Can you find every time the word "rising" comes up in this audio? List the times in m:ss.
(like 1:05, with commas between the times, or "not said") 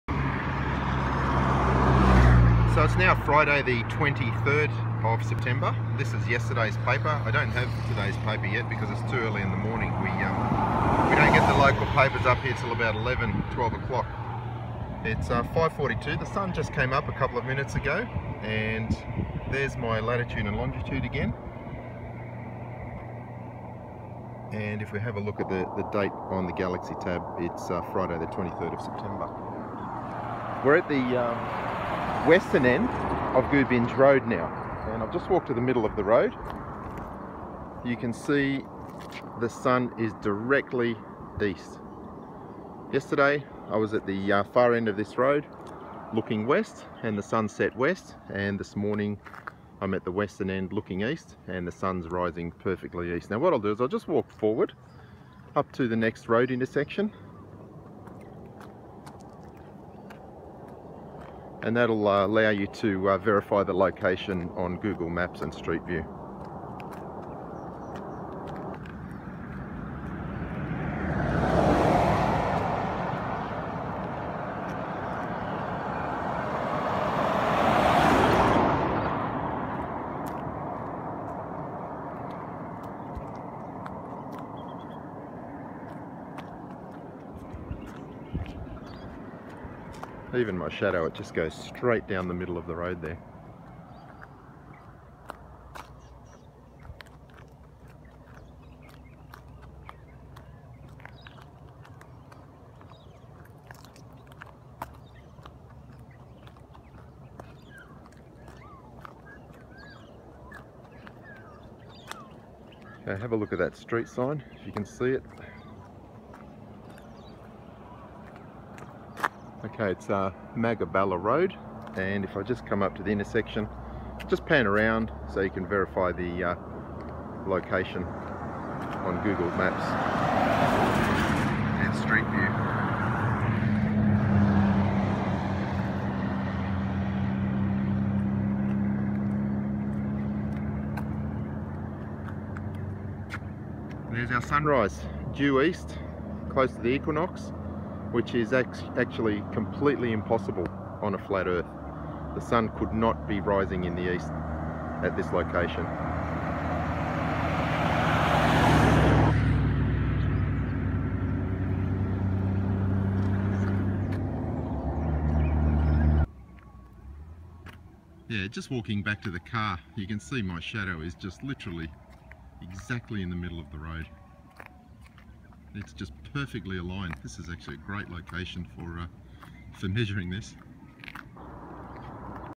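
0:52, 2:33.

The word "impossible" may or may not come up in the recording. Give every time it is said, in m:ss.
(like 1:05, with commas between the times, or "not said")
2:30.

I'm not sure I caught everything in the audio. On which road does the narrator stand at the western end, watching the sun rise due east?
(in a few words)
Gubinge Road.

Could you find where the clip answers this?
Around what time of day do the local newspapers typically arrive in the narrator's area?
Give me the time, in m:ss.
0:12.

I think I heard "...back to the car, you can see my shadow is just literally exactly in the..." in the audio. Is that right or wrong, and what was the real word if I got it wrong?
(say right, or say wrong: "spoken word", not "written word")
right.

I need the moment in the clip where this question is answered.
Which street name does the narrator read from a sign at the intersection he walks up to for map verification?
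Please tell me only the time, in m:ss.
2:00.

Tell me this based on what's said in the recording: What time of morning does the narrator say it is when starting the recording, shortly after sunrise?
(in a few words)
5:42.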